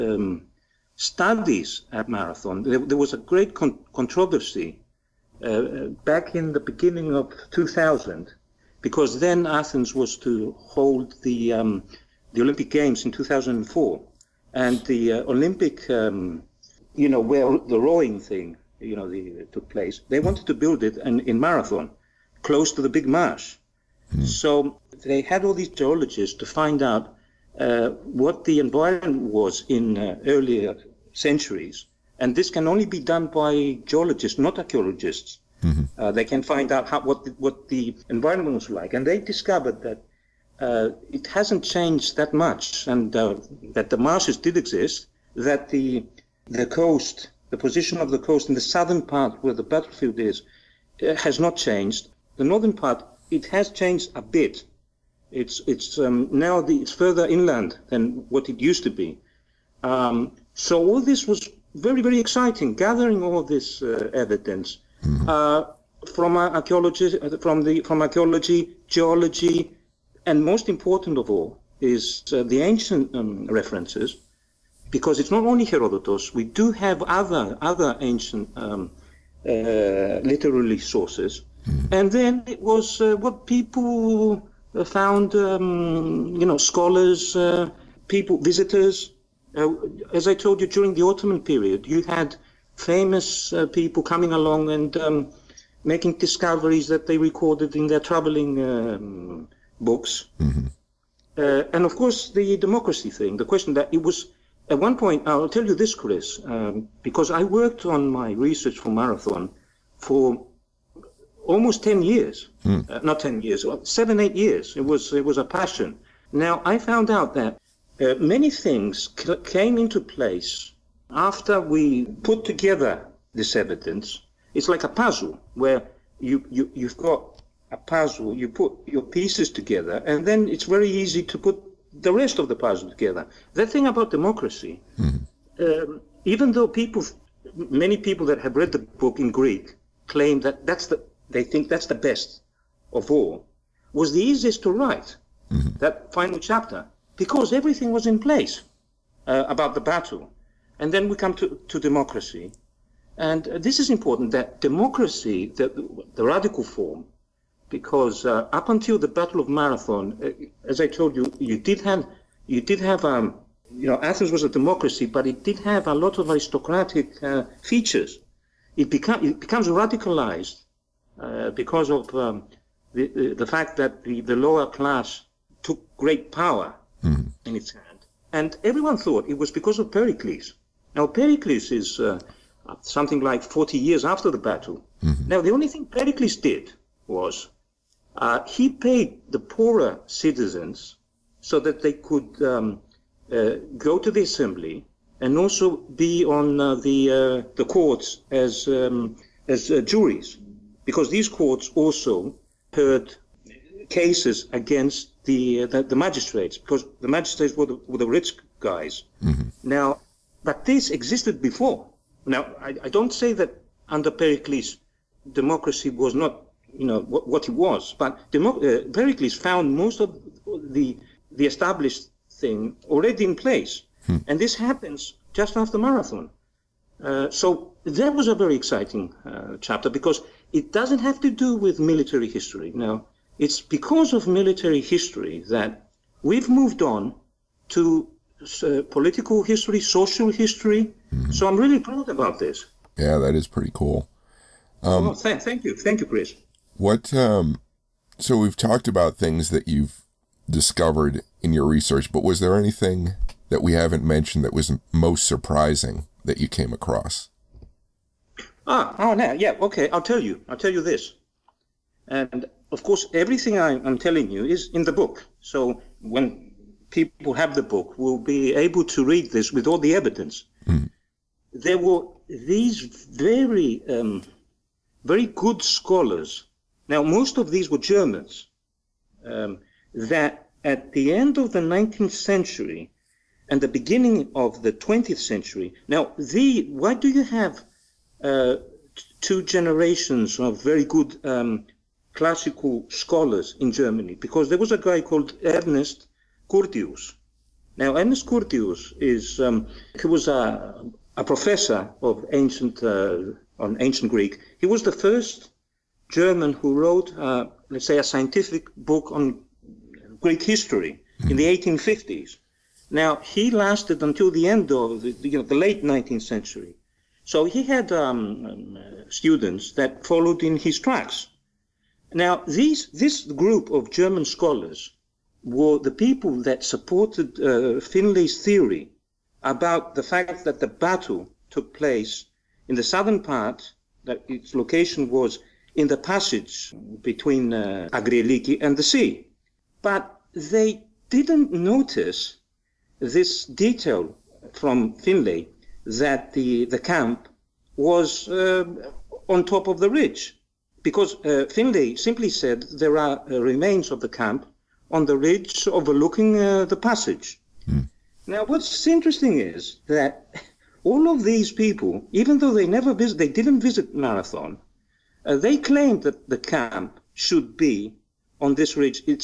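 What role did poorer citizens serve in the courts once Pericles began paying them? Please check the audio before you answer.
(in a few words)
juries.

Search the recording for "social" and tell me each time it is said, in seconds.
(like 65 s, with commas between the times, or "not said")
239 s.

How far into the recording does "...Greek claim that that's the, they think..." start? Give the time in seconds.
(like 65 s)
139 s.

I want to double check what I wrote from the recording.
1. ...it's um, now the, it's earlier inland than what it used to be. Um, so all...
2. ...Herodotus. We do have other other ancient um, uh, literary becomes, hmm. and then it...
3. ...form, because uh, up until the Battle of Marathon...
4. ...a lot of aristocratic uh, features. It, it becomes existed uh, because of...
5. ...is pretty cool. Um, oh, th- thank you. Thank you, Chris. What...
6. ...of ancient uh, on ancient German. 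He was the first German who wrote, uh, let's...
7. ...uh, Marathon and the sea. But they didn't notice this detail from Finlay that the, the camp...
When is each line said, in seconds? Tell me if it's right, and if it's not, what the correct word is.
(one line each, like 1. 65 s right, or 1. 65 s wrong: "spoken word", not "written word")
1. 55 s wrong: "further", not "earlier"
2. 75 s wrong: "sources", not "becomes"
3. 156 s right
4. 165 s wrong: "radicalized", not "existed"
5. 243 s right
6. 302 s wrong: "Greek", not "German"
7. 337 s wrong: "Agrieliki", not "Marathon".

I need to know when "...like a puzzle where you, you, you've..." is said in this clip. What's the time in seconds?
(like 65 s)
124 s.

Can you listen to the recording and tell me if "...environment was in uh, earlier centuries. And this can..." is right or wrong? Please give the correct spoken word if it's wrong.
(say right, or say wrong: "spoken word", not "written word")
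right.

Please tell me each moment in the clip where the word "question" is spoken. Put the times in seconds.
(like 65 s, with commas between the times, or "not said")
103 s.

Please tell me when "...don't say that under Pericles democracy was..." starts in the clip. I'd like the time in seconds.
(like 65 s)
212 s.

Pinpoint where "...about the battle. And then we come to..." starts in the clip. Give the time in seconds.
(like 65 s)
149 s.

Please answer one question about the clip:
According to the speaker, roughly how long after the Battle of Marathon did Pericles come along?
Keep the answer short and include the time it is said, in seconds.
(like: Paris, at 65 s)
40 years, at 183 s.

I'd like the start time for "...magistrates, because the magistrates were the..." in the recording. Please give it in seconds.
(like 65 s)
205 s.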